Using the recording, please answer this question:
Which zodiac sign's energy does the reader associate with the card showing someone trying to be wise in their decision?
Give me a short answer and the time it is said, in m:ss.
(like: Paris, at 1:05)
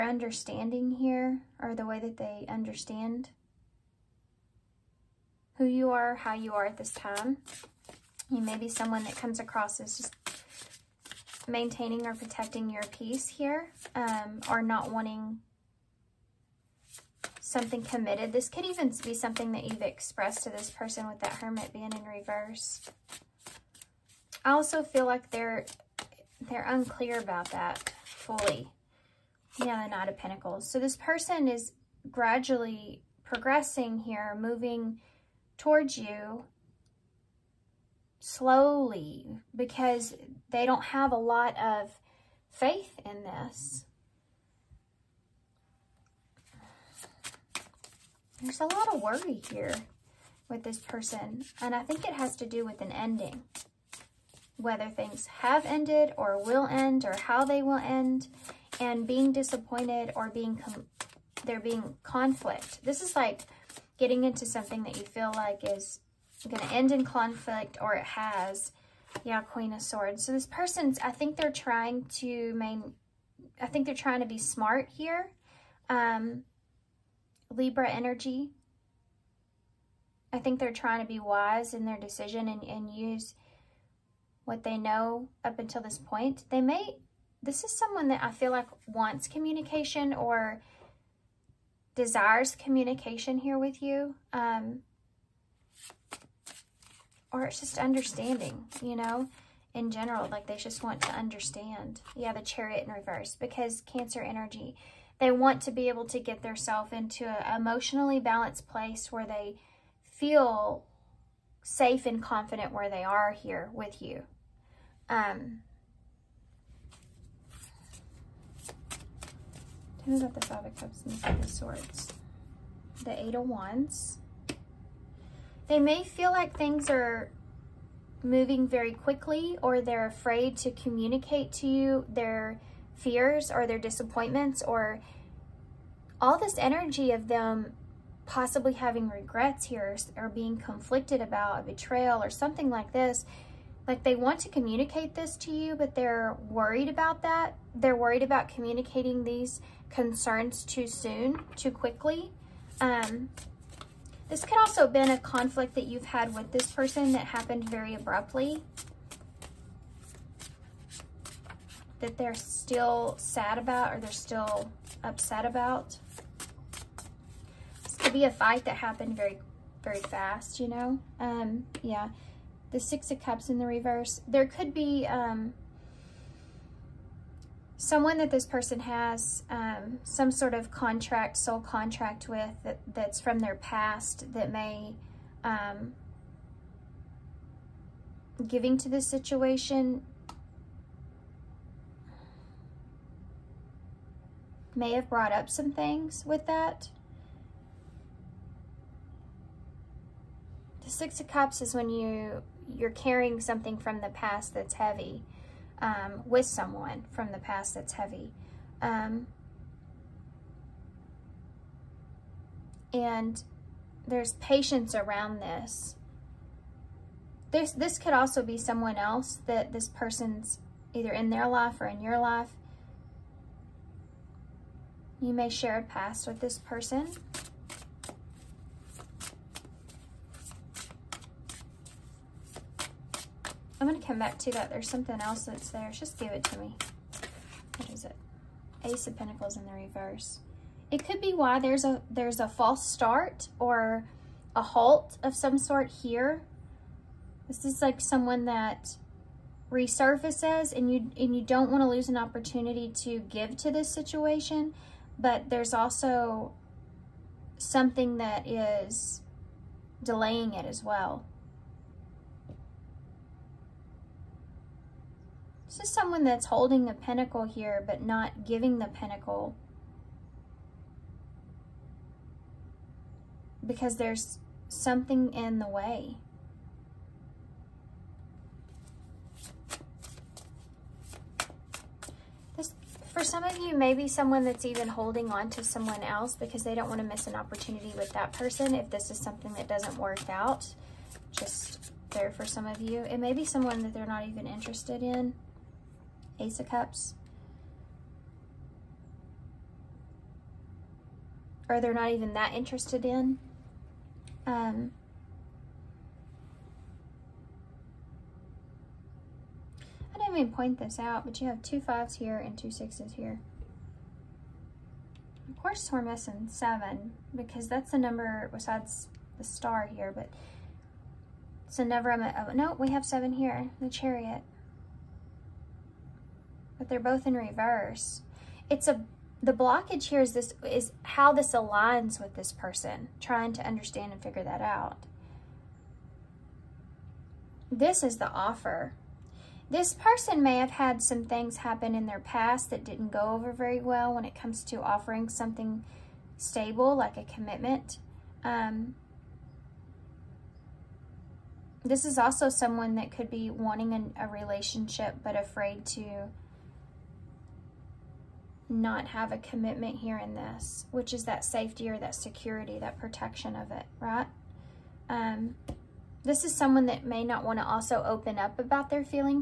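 Libra, at 1:17.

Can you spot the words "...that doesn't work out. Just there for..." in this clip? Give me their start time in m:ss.
4:49.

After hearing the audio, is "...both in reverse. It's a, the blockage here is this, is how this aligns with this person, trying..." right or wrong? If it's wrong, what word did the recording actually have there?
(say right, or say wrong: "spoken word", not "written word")
right.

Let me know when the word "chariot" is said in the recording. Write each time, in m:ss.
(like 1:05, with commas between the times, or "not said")
1:42, 5:23.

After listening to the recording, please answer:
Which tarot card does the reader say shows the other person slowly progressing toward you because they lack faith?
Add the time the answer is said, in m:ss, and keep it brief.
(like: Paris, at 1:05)
Knight of Pentacles, at 0:29.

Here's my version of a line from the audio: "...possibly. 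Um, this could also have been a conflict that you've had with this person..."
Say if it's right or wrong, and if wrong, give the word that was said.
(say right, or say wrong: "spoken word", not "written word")
wrong: "quickly", not "possibly".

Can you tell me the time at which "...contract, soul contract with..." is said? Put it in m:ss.
3:00.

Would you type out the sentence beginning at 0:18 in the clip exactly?
This could even be something that you've expressed to this person with that hermit being in reverse.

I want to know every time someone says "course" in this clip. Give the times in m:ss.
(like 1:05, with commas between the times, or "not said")
5:15.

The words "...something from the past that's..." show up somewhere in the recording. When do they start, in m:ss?
3:23.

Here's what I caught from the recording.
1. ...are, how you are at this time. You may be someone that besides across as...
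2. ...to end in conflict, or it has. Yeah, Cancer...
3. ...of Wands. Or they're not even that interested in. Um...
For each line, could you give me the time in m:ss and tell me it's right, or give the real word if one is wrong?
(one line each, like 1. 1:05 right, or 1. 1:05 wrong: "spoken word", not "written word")
1. 0:05 wrong: "comes", not "besides"
2. 1:06 wrong: "Queen", not "Cancer"
3. 4:56 wrong: "Cups", not "Wands".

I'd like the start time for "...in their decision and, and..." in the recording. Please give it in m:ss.
1:21.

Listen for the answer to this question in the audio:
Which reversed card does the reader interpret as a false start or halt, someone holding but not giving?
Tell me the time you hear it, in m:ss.
3:58.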